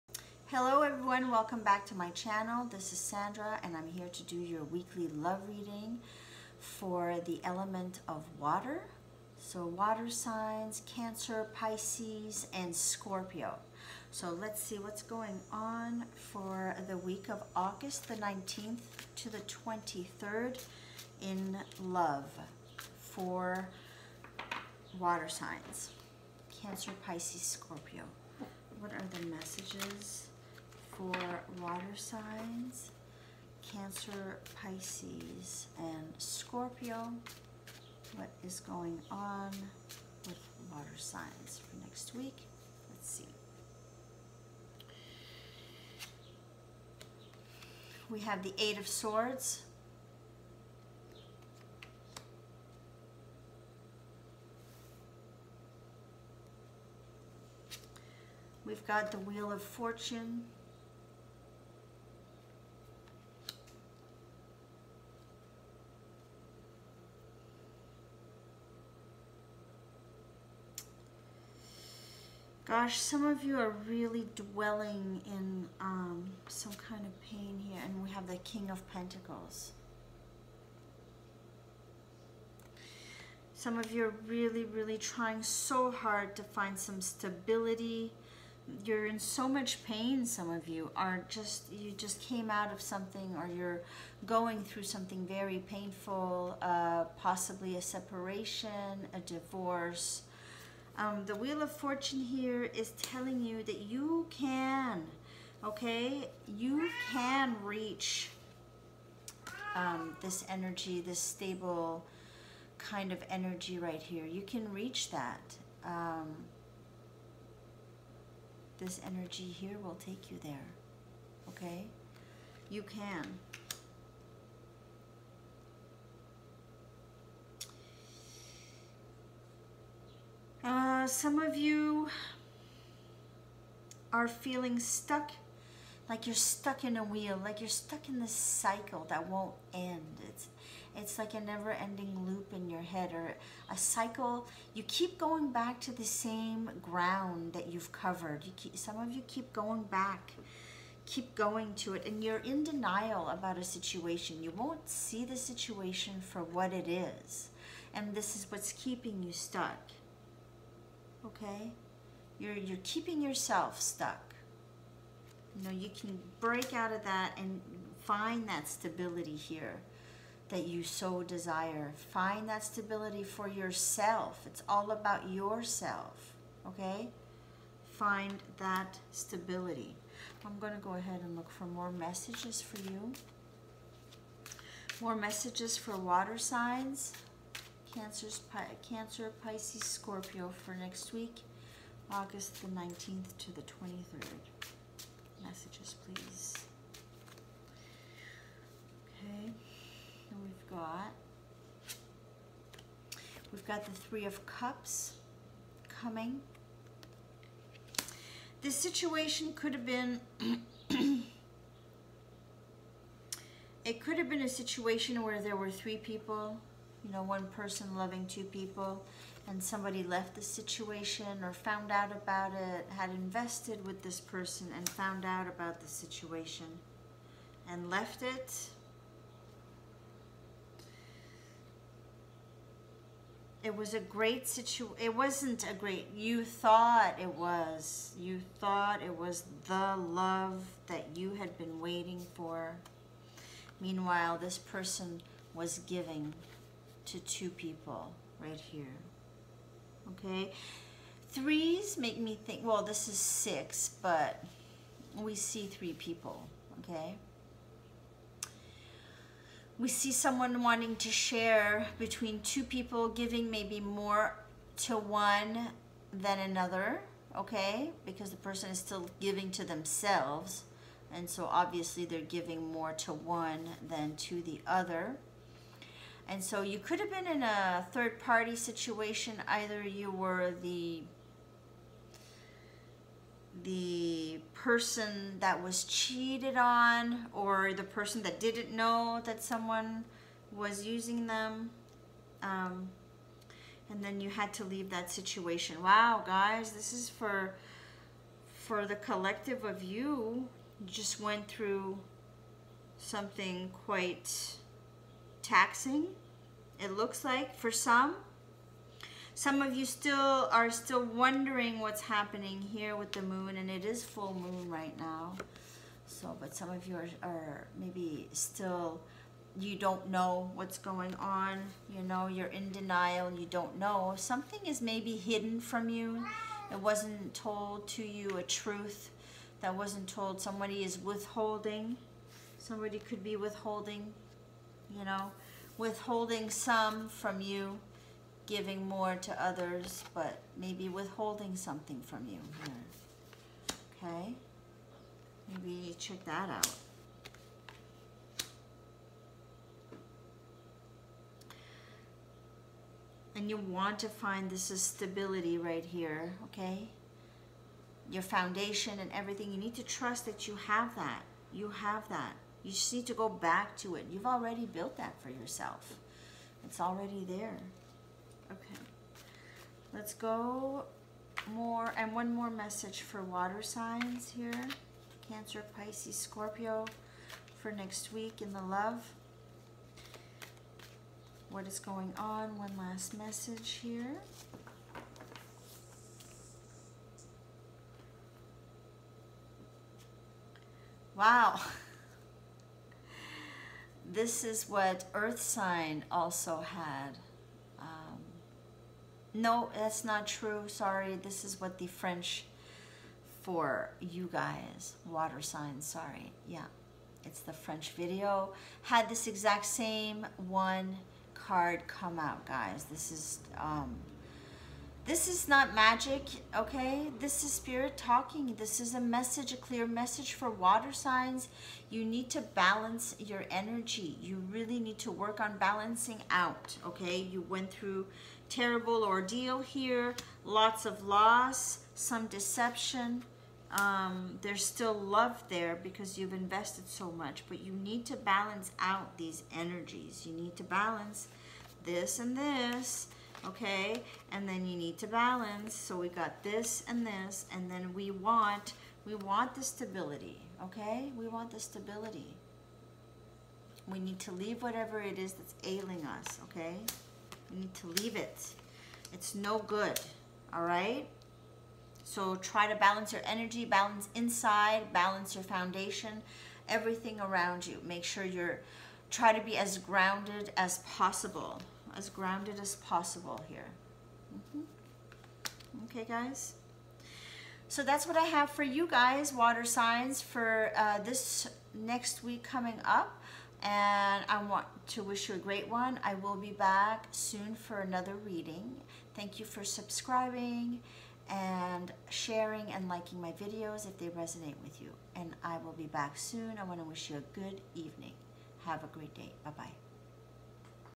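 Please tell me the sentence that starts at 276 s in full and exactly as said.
And so you could have been in a third party situation.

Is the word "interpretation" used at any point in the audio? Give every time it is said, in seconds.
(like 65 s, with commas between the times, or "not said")
not said.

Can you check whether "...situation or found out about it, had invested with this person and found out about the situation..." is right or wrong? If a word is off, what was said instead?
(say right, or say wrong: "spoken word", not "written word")
right.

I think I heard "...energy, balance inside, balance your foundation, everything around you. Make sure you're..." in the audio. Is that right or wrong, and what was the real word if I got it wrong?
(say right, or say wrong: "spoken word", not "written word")
right.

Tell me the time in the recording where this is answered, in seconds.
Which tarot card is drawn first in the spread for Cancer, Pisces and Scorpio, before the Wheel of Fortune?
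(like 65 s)
48 s.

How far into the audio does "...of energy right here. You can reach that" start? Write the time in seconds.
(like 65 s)
113 s.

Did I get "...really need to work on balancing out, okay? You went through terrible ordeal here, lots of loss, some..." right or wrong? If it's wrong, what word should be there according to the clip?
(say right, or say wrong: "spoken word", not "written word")
right.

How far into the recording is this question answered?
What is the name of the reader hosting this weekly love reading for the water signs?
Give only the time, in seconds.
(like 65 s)
2 s.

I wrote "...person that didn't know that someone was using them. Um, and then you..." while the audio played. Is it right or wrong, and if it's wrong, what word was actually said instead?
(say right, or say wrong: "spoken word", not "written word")
right.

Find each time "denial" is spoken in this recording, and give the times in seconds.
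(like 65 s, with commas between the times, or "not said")
152 s, 322 s.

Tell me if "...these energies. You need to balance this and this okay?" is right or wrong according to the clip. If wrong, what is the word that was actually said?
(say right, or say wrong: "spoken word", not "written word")
right.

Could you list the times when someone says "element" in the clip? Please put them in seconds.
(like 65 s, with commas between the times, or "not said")
7 s.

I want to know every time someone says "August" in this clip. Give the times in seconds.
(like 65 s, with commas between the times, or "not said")
17 s, 192 s.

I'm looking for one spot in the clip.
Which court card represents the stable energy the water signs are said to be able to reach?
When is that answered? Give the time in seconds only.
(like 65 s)
78 s.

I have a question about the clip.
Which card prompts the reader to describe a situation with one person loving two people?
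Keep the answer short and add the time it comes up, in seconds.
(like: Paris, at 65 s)
Three of Cups, at 203 s.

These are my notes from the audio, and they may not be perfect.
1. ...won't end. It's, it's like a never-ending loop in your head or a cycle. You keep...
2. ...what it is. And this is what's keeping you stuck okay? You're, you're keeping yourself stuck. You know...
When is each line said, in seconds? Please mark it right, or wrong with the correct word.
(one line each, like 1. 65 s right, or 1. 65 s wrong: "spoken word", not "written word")
1. 139 s right
2. 156 s right.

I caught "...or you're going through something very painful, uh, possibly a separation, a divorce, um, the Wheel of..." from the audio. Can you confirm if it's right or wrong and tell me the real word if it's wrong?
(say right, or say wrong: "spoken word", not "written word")
right.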